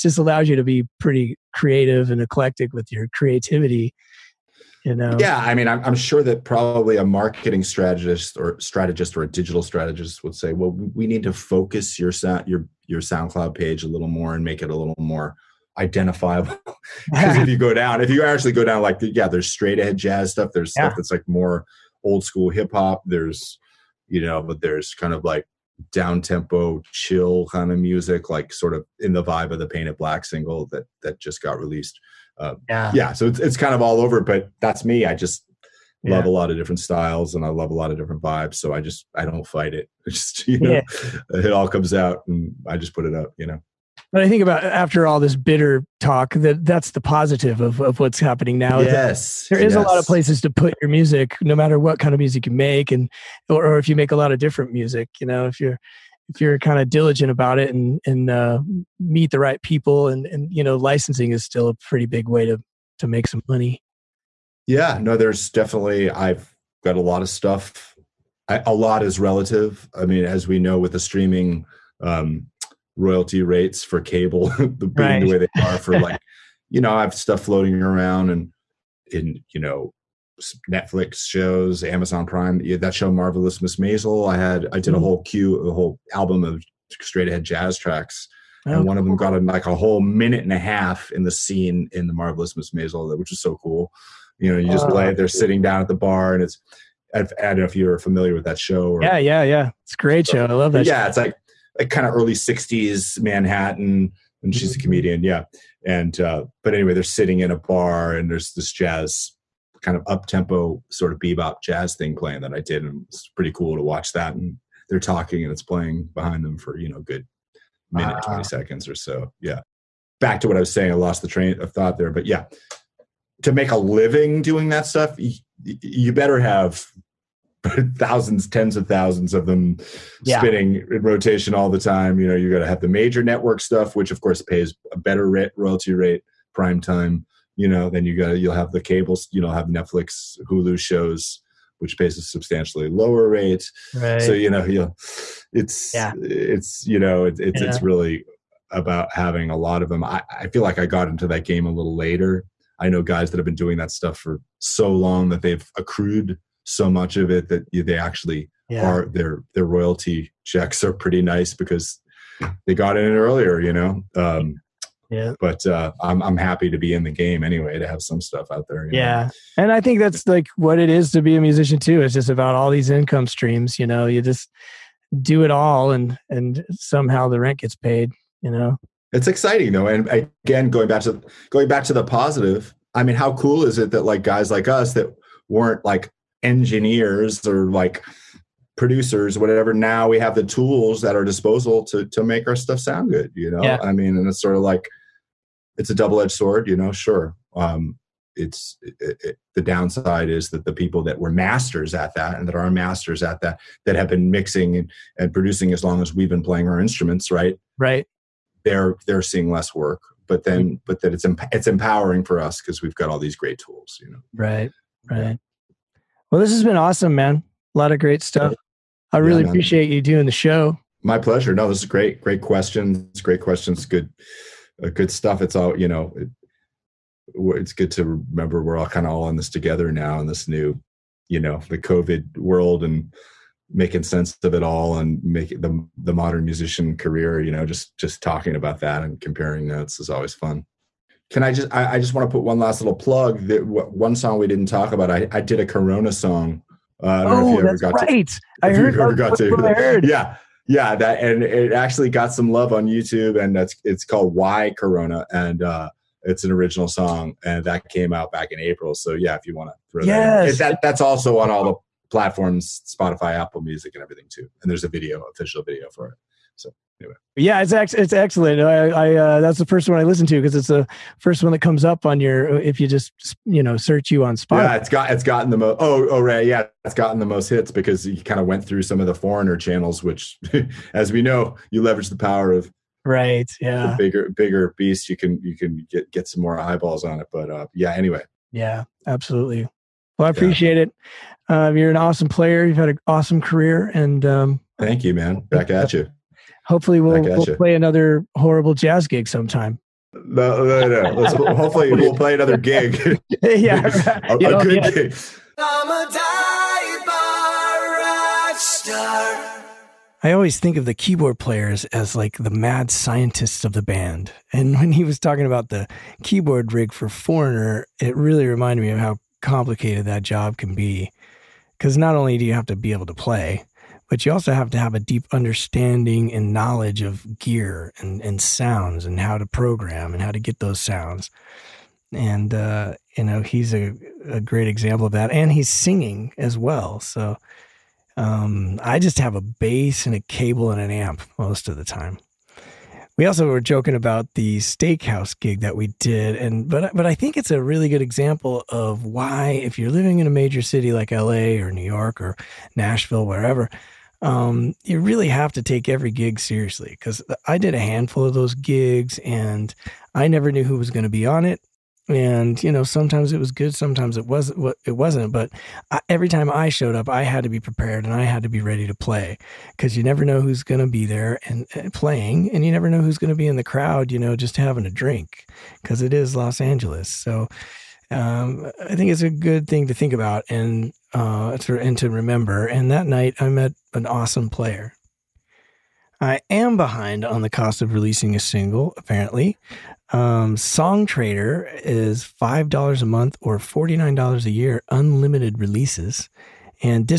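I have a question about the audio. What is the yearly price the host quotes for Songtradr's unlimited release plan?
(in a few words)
$49.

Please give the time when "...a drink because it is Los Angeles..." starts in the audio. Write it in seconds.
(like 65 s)
374 s.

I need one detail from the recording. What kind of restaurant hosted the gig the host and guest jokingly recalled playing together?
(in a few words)
Steakhouse.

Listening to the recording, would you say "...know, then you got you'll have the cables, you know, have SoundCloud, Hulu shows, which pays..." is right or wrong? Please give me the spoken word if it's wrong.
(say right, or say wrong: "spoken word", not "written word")
wrong: "Netflix", not "SoundCloud".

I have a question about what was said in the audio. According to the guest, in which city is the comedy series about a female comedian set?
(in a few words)
Manhattan.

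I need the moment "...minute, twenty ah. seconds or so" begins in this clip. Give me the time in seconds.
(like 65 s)
117 s.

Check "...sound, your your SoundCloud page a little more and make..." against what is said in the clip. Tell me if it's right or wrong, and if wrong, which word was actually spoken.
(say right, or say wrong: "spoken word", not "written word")
right.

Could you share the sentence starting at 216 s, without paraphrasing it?
Well, this has been awesome, man.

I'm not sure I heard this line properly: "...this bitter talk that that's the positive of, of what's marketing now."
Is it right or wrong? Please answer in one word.
wrong.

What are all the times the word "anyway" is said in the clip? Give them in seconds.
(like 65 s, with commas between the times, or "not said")
106 s, 167 s, 267 s, 287 s.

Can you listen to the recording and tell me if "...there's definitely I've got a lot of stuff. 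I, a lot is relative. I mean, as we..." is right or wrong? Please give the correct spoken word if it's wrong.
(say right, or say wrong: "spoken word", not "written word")
right.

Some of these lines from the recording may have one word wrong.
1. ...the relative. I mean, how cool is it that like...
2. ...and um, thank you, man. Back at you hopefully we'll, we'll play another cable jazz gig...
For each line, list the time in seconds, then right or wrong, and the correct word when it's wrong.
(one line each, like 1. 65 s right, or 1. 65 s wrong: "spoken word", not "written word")
1. 181 s wrong: "positive", not "relative"
2. 293 s wrong: "horrible", not "cable".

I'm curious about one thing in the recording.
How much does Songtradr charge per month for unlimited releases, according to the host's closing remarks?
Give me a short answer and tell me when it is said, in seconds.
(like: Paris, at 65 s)
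$5, at 392 s.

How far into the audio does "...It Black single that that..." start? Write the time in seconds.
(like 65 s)
29 s.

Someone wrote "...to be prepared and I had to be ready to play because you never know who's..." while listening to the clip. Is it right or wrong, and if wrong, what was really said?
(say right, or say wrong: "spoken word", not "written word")
right.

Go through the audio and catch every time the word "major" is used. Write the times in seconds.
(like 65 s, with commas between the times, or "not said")
132 s, 350 s.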